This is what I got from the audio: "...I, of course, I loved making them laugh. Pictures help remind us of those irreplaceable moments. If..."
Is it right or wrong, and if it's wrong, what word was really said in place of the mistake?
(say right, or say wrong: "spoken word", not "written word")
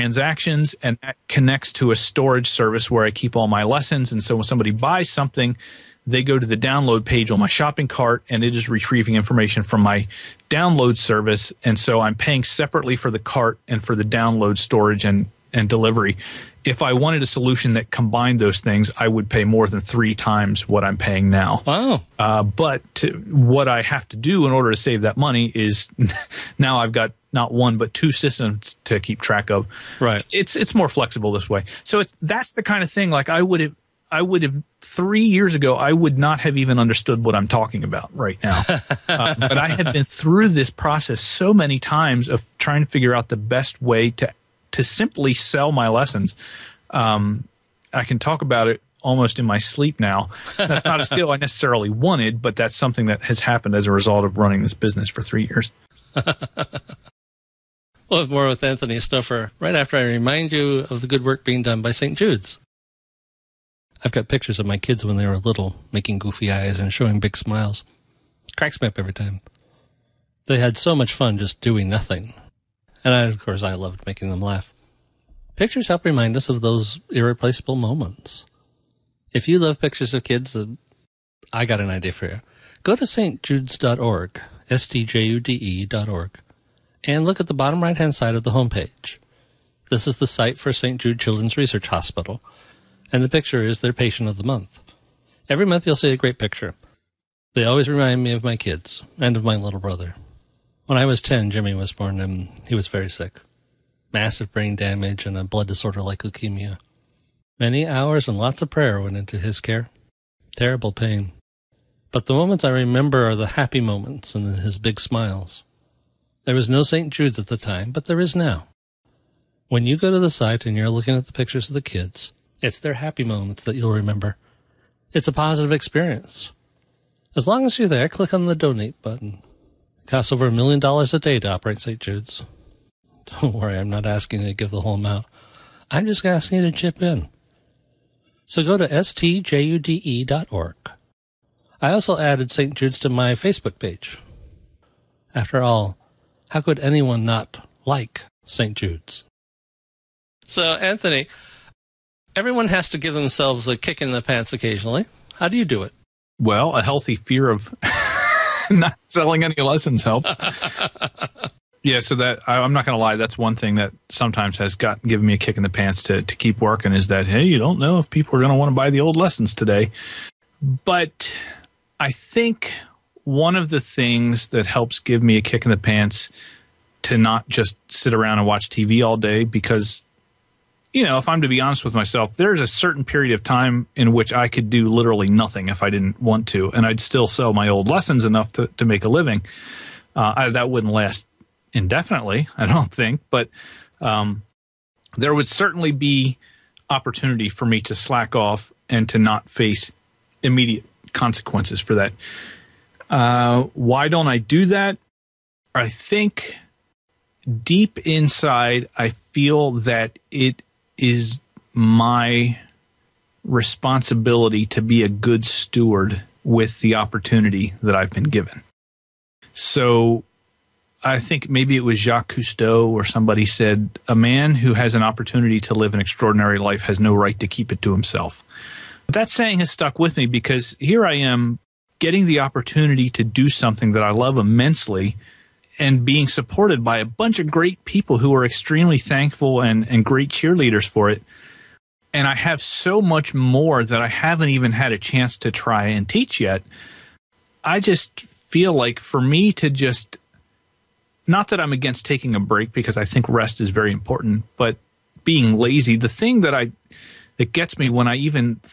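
right.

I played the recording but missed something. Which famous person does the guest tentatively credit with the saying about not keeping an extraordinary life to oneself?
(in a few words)
Jacques Cousteau.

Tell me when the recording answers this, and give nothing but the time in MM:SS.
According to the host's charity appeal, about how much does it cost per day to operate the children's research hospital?
02:10.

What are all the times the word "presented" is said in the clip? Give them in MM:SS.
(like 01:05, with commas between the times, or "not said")
not said.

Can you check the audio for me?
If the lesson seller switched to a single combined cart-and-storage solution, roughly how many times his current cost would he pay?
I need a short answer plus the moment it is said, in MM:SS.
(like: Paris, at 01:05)
more than 3 times, at 00:19.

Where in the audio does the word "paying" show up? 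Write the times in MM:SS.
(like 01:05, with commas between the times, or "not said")
00:12, 00:20.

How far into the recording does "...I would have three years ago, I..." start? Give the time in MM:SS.
00:34.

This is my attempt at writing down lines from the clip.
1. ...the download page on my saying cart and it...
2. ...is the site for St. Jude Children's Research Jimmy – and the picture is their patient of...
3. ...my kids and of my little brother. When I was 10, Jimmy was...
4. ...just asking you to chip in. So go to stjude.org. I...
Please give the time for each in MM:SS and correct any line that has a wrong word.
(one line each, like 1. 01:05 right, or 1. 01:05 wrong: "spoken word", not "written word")
1. 00:06 wrong: "shopping", not "saying"
2. 01:30 wrong: "Hospital", not "Jimmy"
3. 01:38 right
4. 02:16 right.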